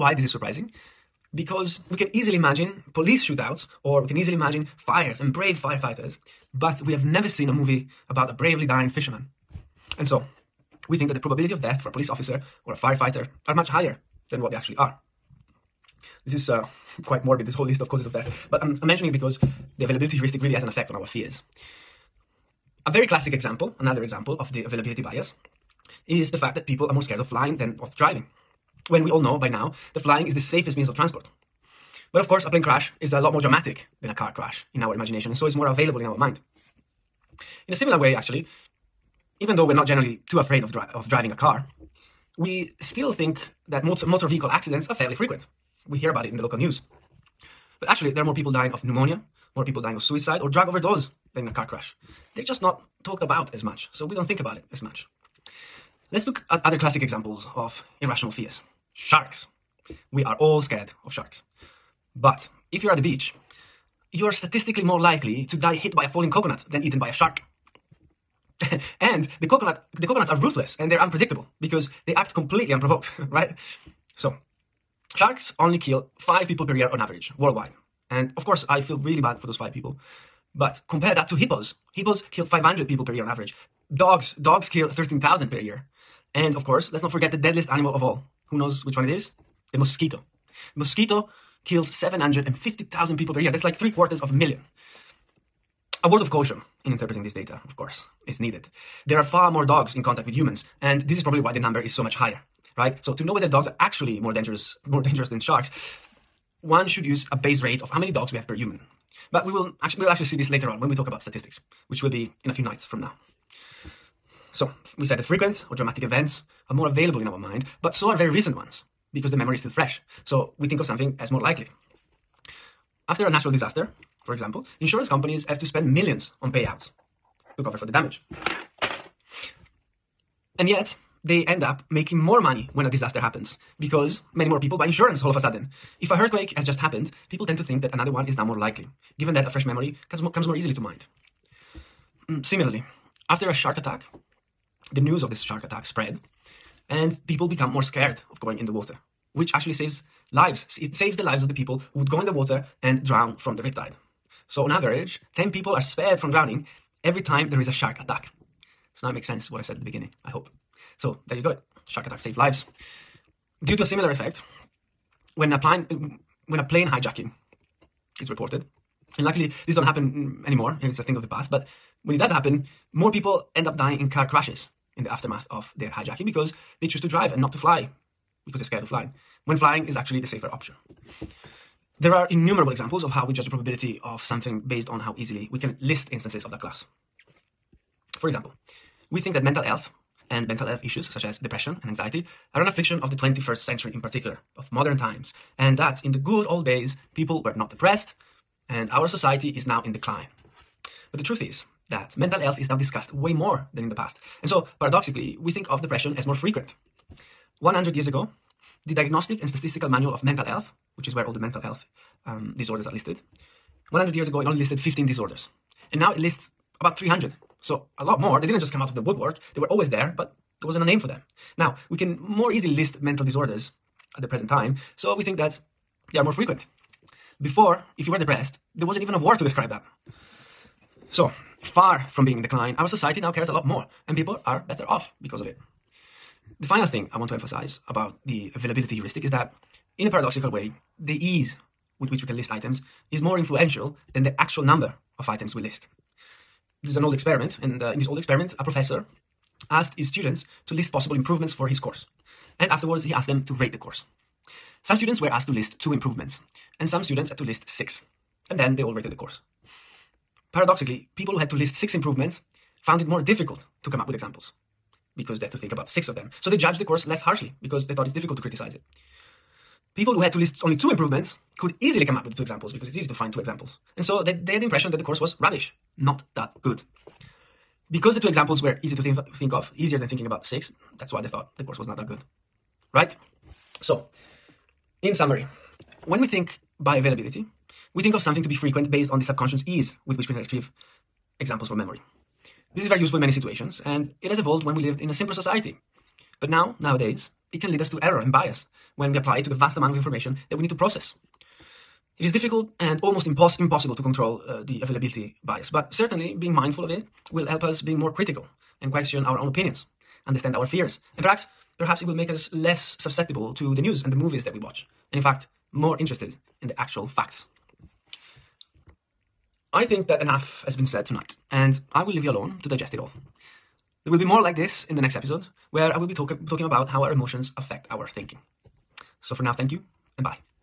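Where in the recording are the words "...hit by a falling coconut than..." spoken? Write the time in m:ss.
1:05.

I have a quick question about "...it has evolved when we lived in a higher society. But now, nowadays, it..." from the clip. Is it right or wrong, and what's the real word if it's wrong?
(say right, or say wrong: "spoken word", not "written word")
wrong: "simpler", not "higher".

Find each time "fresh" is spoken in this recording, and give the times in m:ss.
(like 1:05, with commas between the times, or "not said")
1:59, 2:19.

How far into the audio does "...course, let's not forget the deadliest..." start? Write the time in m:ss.
1:26.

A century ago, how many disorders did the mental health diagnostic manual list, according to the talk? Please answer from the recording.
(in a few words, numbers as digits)
15.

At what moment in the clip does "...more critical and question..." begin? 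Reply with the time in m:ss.
5:07.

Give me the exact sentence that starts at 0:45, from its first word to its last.
We hear about it in the local news.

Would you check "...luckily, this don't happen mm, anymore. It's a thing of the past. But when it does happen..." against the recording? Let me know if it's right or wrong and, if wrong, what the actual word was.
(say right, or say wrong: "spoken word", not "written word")
right.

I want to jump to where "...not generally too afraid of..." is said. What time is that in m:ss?
0:39.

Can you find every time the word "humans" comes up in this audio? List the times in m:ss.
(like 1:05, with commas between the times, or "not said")
1:40, 1:48.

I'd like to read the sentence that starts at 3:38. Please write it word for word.
They didn't just come out of the woodwork.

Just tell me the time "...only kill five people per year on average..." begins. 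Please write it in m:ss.
1:15.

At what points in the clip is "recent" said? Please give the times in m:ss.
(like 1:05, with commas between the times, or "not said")
1:58.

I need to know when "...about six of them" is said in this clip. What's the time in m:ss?
4:25.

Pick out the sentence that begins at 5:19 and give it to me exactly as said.
I think that enough has been said tonight, and I will leave you alone to digest it all.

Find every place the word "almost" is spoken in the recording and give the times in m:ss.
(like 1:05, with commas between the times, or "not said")
5:03.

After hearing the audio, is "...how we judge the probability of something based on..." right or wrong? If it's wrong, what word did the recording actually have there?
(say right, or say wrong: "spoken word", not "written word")
right.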